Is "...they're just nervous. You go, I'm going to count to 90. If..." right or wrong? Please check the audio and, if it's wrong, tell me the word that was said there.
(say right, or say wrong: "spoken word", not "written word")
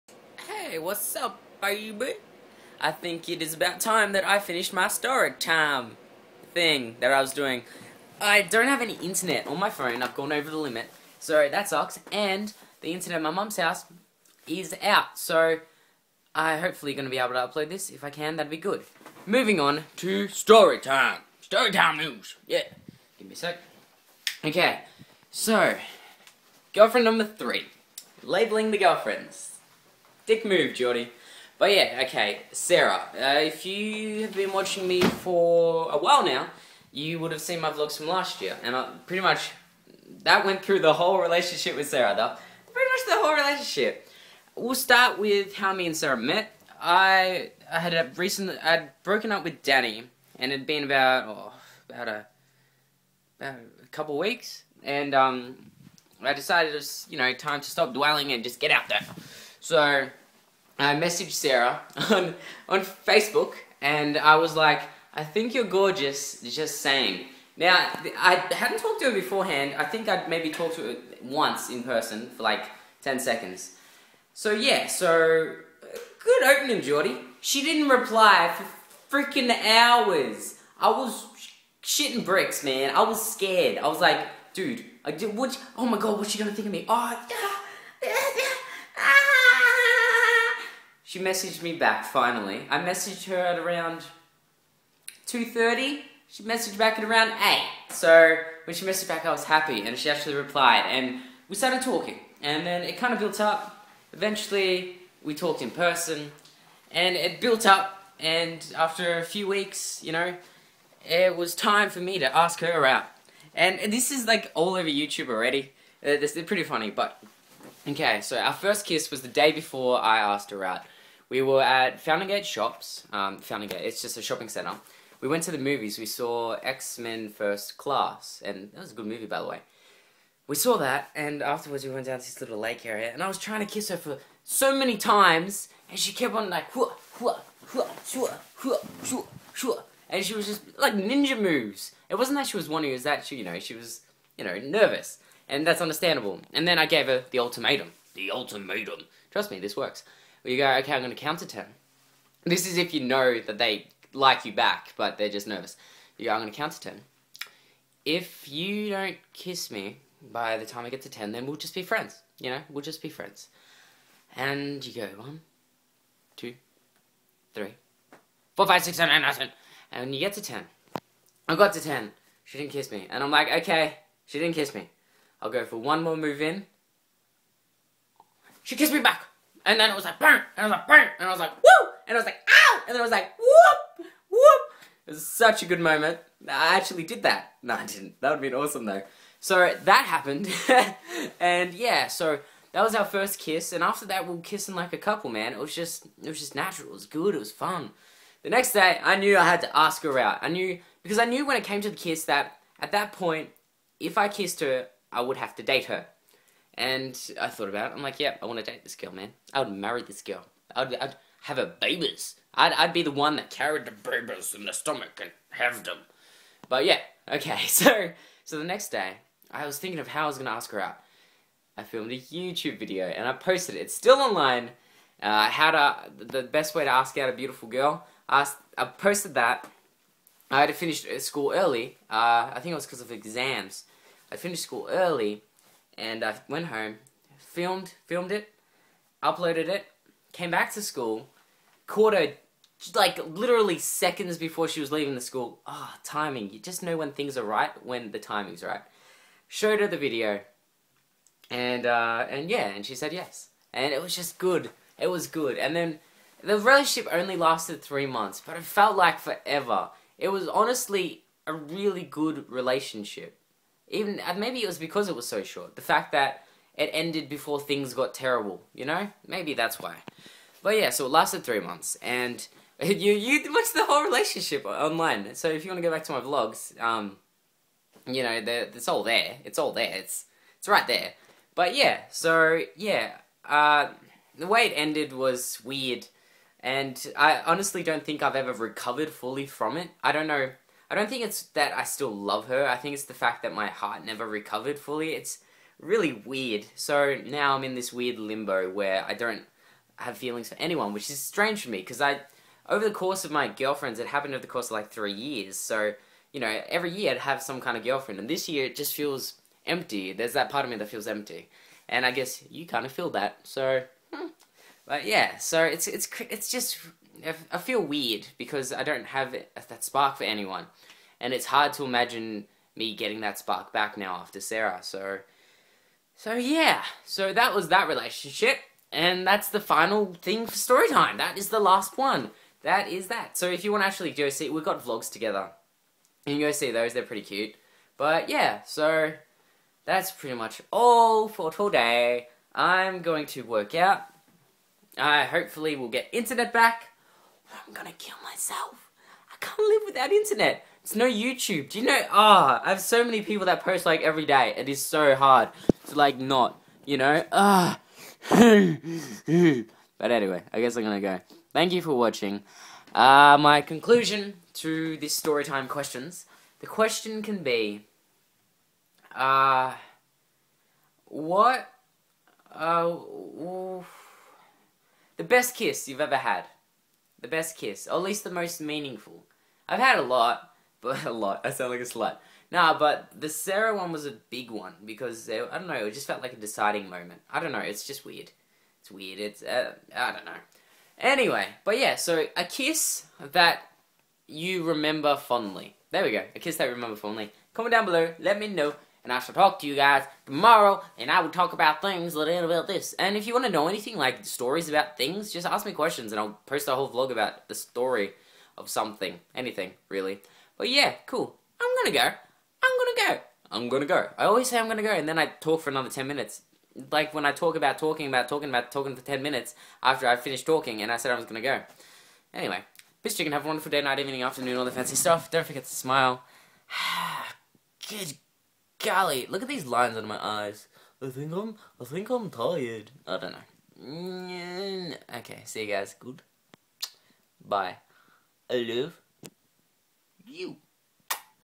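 wrong: "10", not "90".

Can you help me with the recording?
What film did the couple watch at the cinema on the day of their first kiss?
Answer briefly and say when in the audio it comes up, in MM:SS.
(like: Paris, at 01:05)
X-Men First Class, at 02:06.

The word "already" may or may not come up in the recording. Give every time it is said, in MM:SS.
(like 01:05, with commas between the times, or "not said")
01:55.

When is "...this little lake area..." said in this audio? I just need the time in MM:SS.
02:12.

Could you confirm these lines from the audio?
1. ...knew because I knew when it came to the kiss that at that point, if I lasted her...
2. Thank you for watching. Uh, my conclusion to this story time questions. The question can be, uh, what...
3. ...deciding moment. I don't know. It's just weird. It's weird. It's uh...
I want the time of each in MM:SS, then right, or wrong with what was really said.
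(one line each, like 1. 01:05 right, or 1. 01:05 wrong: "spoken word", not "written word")
1. 03:20 wrong: "kissed", not "lasted"
2. 06:01 right
3. 06:26 right.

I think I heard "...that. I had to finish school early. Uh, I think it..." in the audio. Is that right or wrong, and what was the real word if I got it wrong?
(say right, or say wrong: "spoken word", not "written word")
right.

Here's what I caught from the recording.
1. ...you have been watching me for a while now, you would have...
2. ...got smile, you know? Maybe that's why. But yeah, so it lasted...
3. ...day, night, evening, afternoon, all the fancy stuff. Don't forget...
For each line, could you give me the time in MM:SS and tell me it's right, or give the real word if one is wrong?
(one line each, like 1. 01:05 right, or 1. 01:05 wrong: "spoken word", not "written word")
1. 00:33 right
2. 04:27 wrong: "terrible", not "smile"
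3. 07:03 right.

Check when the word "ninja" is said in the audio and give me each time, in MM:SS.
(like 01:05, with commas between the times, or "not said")
02:20.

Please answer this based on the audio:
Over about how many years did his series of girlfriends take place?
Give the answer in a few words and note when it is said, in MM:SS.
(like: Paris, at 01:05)
3 years, at 05:04.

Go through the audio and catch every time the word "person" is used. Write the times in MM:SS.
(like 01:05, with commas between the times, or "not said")
01:11, 01:45.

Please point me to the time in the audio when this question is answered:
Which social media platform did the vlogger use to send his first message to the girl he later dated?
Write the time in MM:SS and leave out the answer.
01:02.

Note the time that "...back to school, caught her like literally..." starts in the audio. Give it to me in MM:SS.
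04:00.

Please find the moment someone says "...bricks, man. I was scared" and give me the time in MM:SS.
01:22.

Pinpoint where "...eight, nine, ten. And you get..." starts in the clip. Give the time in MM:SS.
02:49.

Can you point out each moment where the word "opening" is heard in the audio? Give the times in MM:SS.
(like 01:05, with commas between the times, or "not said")
01:16.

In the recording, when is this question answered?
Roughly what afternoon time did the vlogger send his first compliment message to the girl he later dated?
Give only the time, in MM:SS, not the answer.
01:35.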